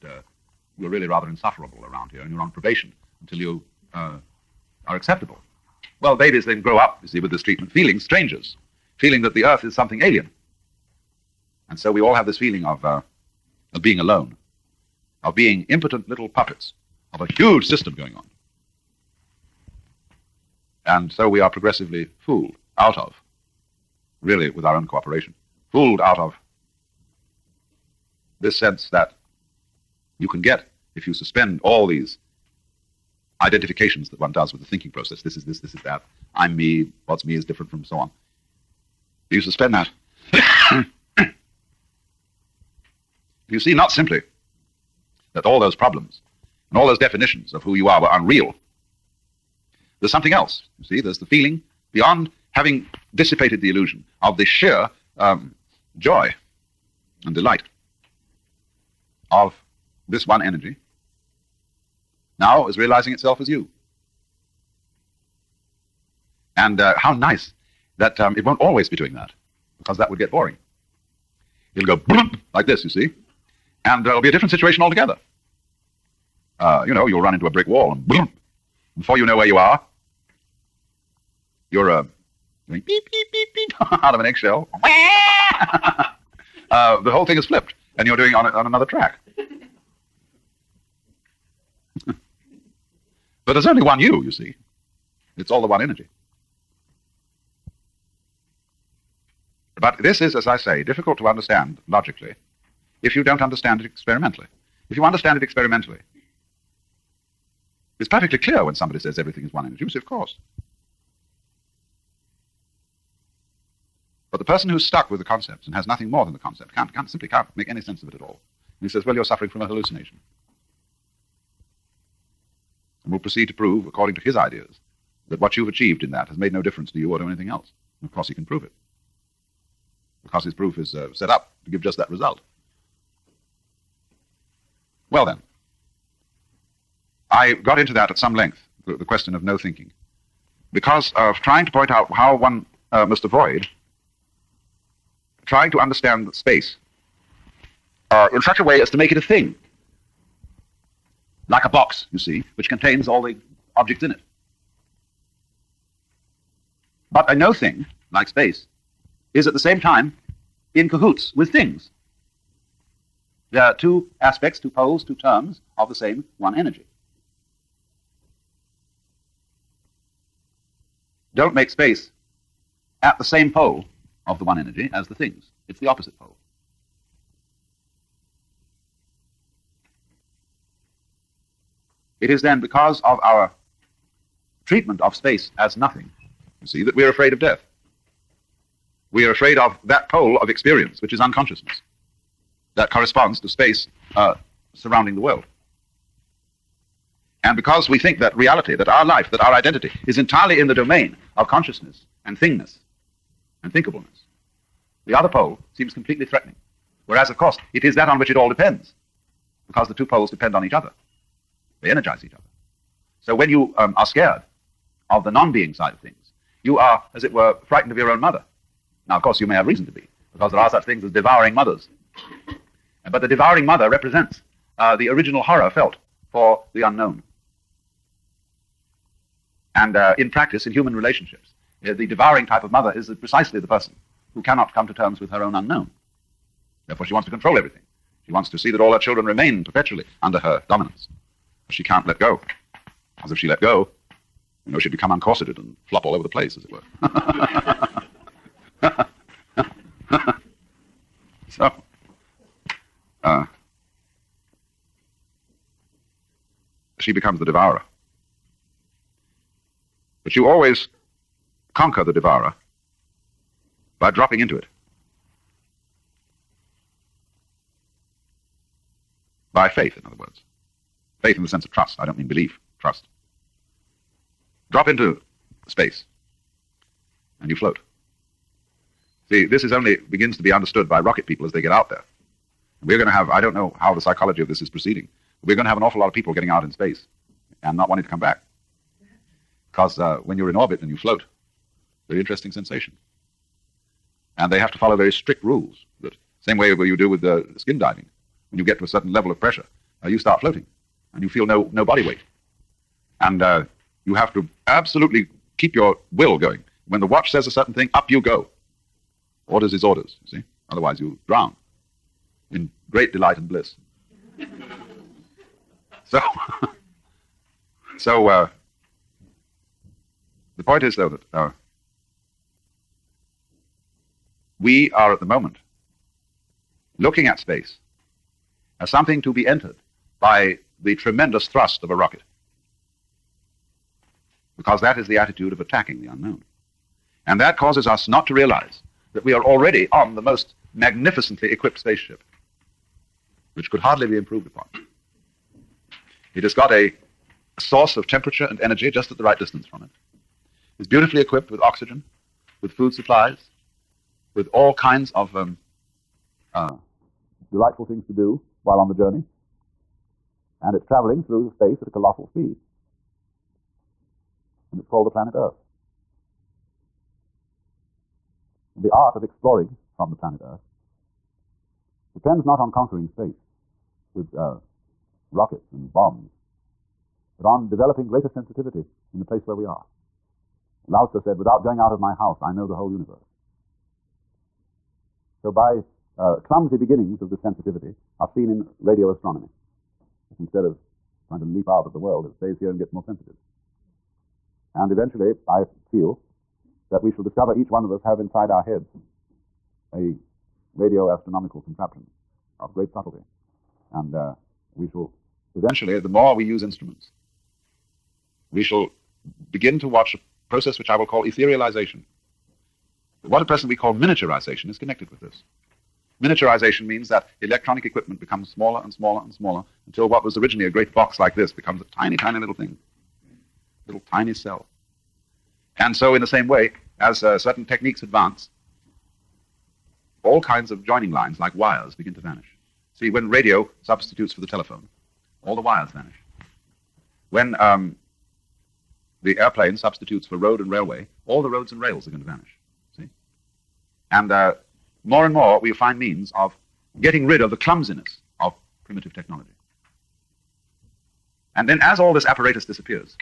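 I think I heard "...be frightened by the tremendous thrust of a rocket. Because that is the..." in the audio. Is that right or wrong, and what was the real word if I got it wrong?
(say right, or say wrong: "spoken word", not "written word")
wrong: "entered", not "frightened".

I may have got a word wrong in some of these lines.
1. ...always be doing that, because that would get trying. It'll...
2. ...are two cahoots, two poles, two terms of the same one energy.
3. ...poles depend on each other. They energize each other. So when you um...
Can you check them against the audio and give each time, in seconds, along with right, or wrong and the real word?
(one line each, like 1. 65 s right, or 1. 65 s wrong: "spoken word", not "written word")
1. 68 s wrong: "boring", not "trying"
2. 163 s wrong: "aspects", not "cahoots"
3. 210 s right.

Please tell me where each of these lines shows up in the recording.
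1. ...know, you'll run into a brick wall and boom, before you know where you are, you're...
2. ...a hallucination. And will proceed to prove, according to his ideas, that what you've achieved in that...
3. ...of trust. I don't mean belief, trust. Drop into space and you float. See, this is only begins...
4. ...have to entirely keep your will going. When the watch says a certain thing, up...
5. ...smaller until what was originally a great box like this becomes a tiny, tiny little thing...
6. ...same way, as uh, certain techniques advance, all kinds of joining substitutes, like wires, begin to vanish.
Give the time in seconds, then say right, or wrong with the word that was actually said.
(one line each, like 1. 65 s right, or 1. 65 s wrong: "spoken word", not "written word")
1. 76 s right
2. 119 s right
3. 271 s right
4. 304 s wrong: "absolutely", not "entirely"
5. 419 s right
6. 426 s wrong: "lines", not "substitutes".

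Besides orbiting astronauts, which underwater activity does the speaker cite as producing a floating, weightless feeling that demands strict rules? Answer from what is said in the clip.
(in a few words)
Skin diving.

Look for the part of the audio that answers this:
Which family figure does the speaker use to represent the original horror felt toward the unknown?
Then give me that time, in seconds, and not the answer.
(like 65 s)
223 s.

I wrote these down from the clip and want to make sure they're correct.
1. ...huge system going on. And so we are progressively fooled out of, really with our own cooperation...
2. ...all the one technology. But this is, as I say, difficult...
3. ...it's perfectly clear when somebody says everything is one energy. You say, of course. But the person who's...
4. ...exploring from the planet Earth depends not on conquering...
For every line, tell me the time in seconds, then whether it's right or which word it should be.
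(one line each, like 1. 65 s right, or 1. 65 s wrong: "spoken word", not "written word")
1. 17 s right
2. 95 s wrong: "energy", not "technology"
3. 107 s right
4. 369 s right.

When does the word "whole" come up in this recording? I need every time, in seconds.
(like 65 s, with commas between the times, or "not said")
87 s, 382 s.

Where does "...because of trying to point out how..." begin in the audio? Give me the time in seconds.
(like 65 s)
140 s.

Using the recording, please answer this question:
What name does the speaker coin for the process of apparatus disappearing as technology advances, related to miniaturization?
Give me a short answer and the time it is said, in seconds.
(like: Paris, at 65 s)
Etherealization, at 411 s.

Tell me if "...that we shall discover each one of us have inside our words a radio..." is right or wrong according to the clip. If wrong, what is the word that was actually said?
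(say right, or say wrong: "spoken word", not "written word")
wrong: "heads", not "words".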